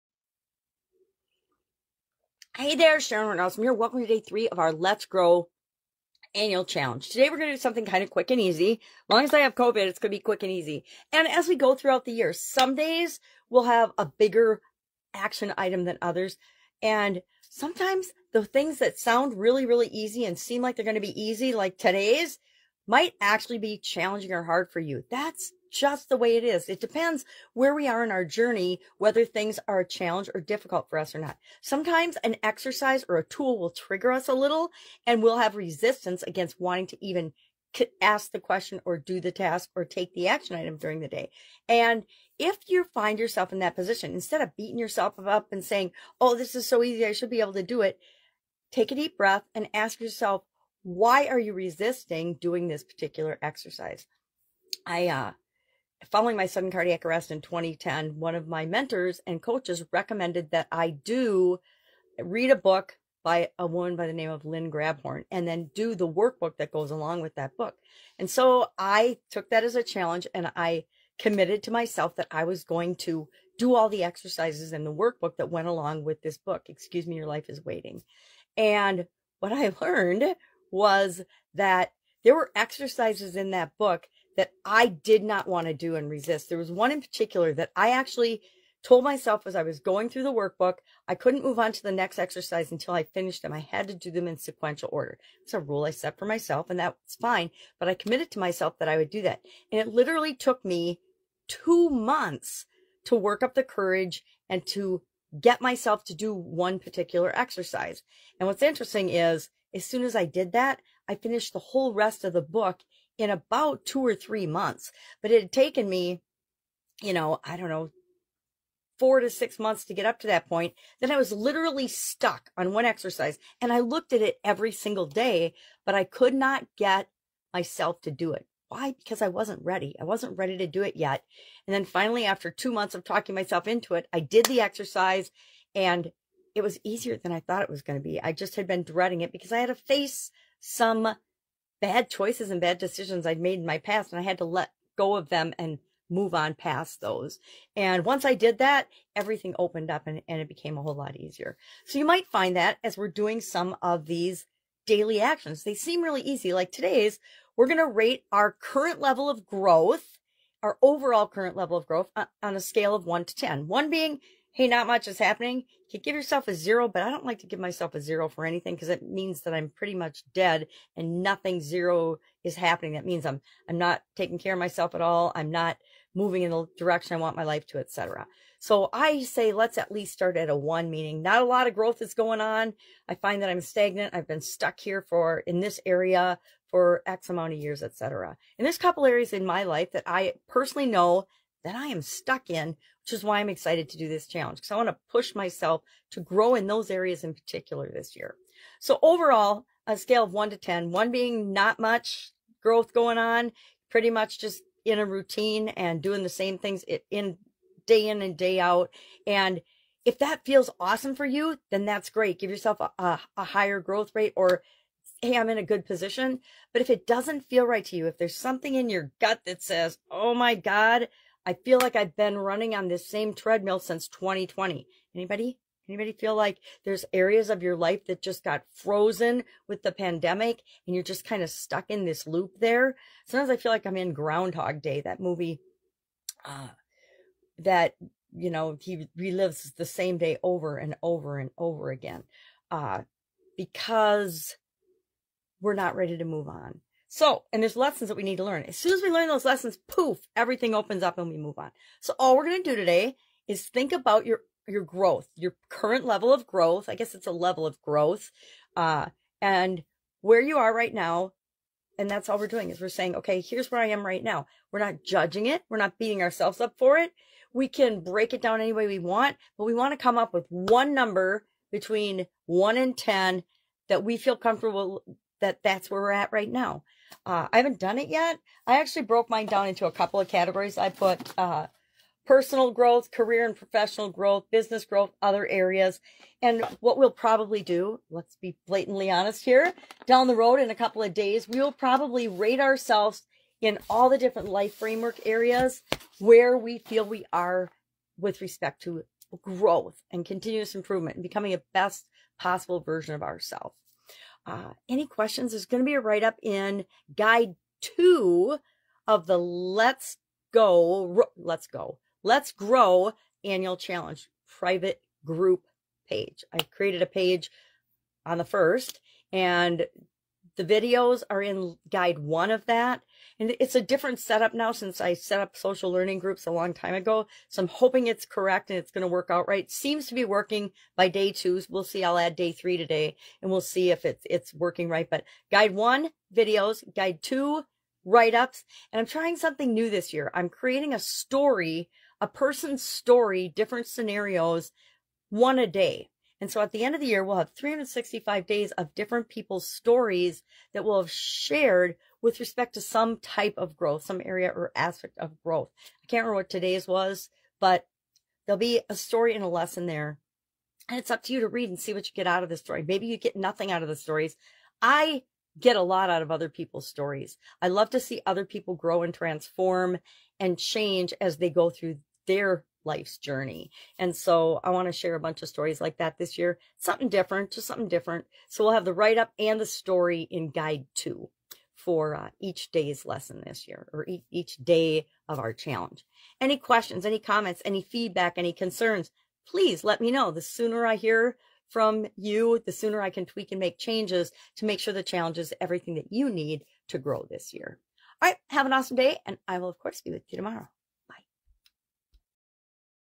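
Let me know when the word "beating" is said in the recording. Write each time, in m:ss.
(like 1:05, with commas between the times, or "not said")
0:44, 4:25.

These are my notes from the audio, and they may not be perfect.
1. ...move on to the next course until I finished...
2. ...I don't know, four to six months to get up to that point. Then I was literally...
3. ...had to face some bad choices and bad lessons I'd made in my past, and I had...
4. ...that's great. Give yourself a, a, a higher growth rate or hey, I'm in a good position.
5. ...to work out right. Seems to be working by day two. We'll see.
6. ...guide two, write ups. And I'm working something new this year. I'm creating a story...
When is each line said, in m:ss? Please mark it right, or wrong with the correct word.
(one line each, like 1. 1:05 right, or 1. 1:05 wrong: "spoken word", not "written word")
1. 1:31 wrong: "exercise", not "course"
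2. 1:57 right
3. 2:19 wrong: "decisions", not "lessons"
4. 3:31 right
5. 5:29 right
6. 5:36 wrong: "trying", not "working".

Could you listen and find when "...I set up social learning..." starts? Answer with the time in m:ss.
5:25.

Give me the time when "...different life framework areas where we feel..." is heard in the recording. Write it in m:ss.
4:54.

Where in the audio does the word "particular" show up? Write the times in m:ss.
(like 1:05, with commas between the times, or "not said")
0:52, 1:27, 1:46, 3:17.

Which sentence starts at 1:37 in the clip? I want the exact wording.
But I committed to myself that I would do that.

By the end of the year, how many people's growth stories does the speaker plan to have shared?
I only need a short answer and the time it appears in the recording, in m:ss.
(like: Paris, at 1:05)
365, at 5:47.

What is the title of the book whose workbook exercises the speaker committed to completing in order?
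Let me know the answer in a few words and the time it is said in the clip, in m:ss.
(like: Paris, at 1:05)
Excuse Me, Your Life Is Waiting, at 1:16.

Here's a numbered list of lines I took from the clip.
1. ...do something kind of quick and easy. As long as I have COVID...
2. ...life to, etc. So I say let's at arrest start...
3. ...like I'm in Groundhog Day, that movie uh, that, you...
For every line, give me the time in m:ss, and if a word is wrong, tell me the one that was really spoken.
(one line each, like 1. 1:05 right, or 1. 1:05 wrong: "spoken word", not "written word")
1. 0:07 right
2. 2:57 wrong: "least", not "arrest"
3. 3:53 right.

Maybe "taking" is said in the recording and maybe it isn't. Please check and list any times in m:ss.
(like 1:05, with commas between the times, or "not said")
2:54.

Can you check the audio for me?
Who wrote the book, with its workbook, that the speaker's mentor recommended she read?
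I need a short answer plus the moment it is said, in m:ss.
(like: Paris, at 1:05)
Lynn Grabhorn, at 1:04.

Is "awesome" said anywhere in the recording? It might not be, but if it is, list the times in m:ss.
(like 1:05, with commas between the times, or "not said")
3:30, 6:38.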